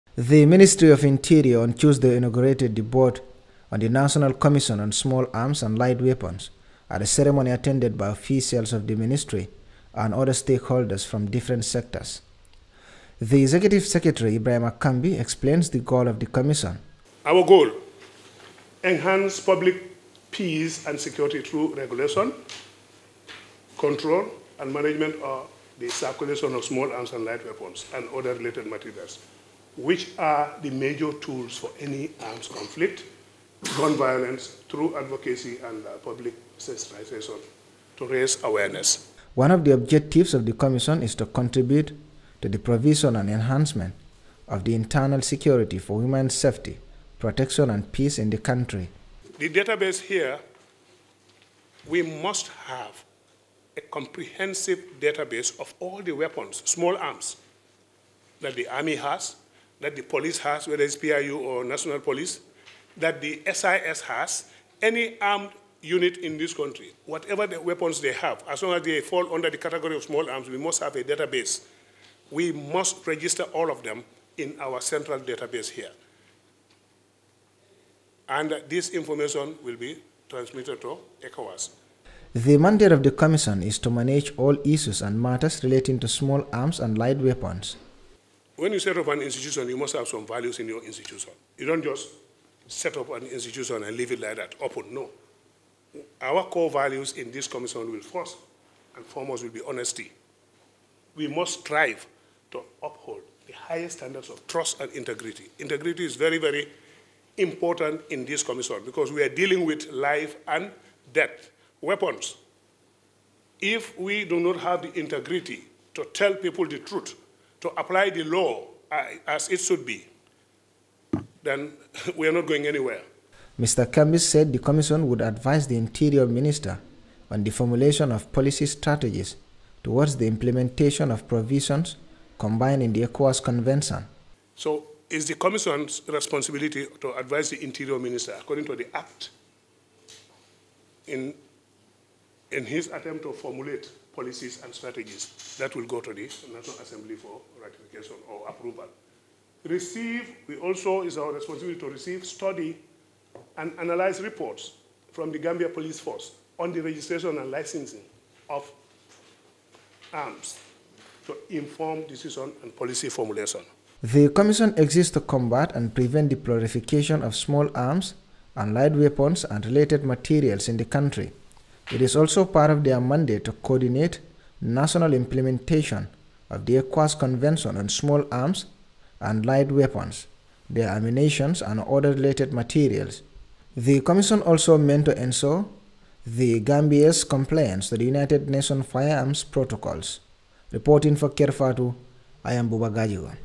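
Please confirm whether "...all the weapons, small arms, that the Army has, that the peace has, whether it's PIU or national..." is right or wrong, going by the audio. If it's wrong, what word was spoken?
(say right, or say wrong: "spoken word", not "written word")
wrong: "police", not "peace".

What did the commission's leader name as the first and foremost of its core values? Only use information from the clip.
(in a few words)
honesty.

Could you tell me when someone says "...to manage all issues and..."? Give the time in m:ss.
1:23.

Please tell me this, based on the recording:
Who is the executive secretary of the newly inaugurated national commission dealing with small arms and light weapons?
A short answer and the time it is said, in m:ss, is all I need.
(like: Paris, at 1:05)
Ibrahim Akambi, at 0:14.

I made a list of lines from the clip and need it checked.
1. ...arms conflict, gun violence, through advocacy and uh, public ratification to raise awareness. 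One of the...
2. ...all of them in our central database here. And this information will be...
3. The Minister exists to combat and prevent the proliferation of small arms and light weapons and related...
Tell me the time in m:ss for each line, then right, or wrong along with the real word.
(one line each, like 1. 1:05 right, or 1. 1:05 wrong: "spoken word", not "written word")
1. 0:32 wrong: "sensitization", not "ratification"
2. 1:13 right
3. 2:44 wrong: "Commission", not "Minister".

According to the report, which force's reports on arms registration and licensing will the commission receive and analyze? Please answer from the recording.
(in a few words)
Gambia Police Force.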